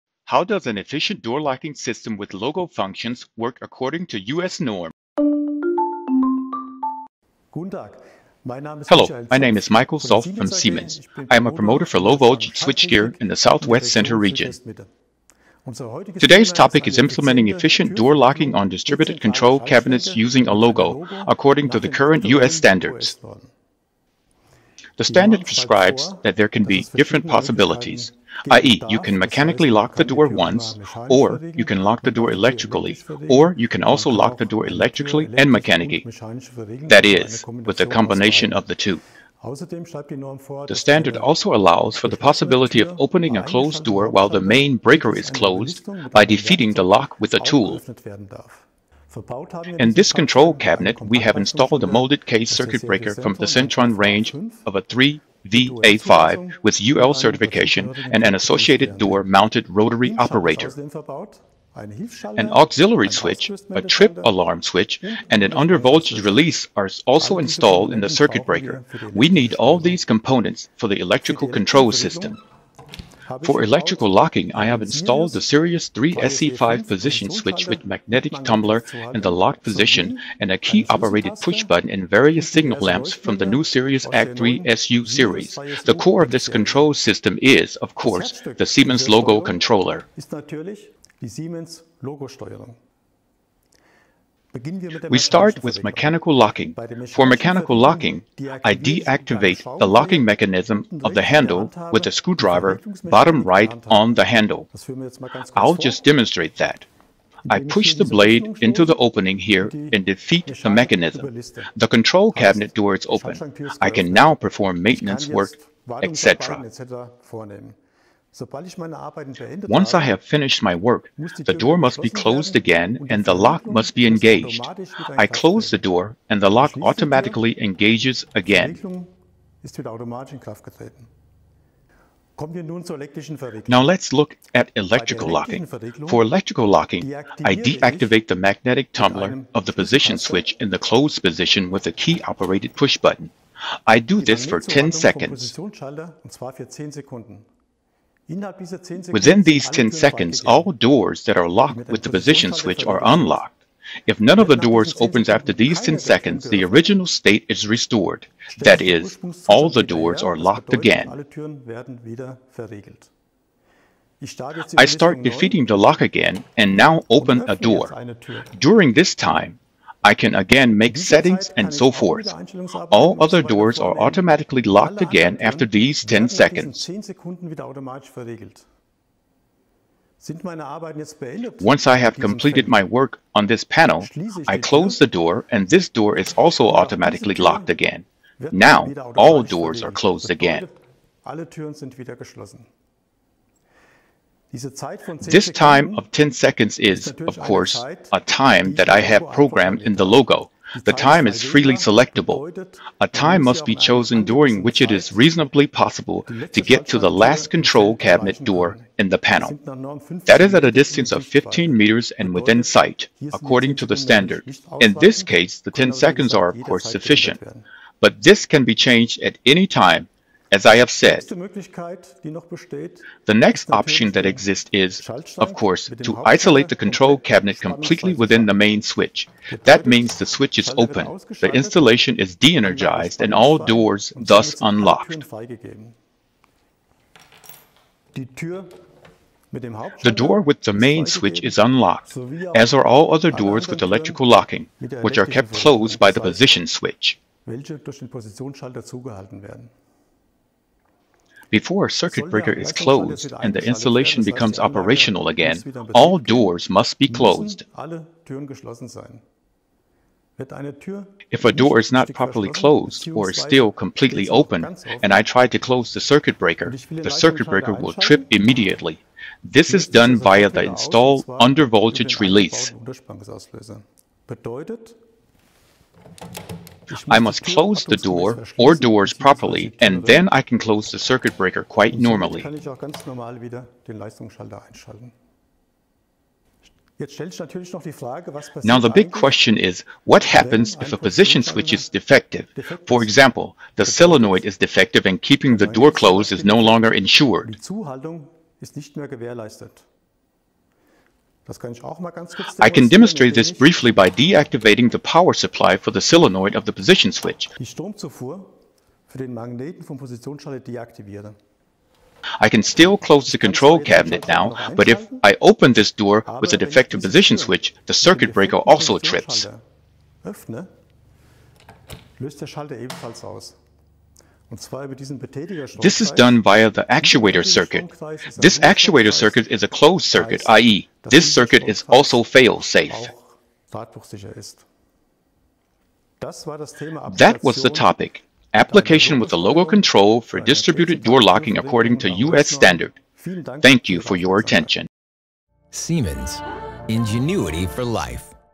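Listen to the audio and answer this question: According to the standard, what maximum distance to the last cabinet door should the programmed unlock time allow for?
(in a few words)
15 meters.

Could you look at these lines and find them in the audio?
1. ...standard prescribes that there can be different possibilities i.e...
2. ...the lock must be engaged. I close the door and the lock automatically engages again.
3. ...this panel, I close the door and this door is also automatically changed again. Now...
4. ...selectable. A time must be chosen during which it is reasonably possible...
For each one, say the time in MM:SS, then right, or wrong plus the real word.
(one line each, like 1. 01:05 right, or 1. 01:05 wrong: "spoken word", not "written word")
1. 00:25 right
2. 02:03 right
3. 03:03 wrong: "locked", not "changed"
4. 03:21 right.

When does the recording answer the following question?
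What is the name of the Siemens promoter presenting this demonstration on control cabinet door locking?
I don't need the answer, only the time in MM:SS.
00:09.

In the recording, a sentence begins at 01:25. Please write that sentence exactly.
The core of this control system is, of course, the Siemens logo controller.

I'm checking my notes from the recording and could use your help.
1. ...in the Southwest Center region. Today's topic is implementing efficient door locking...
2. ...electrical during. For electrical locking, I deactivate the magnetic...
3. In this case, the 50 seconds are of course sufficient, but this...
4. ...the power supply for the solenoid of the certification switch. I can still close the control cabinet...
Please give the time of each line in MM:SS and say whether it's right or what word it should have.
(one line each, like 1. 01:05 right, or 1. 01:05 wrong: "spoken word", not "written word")
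1. 00:13 right
2. 02:14 wrong: "locking", not "during"
3. 03:34 wrong: "10", not "50"
4. 05:04 wrong: "position", not "certification".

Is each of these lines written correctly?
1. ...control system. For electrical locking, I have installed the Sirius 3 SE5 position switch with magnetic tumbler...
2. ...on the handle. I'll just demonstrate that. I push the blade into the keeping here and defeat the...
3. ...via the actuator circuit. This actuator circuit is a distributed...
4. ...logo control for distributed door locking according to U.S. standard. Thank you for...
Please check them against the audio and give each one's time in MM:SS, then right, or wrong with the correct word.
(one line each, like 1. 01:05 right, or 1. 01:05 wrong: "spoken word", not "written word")
1. 01:11 right
2. 01:43 wrong: "opening", not "keeping"
3. 05:26 wrong: "closed", not "distributed"
4. 05:39 right.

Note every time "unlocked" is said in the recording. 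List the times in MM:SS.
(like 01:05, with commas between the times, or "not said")
02:33, 03:54, 04:01.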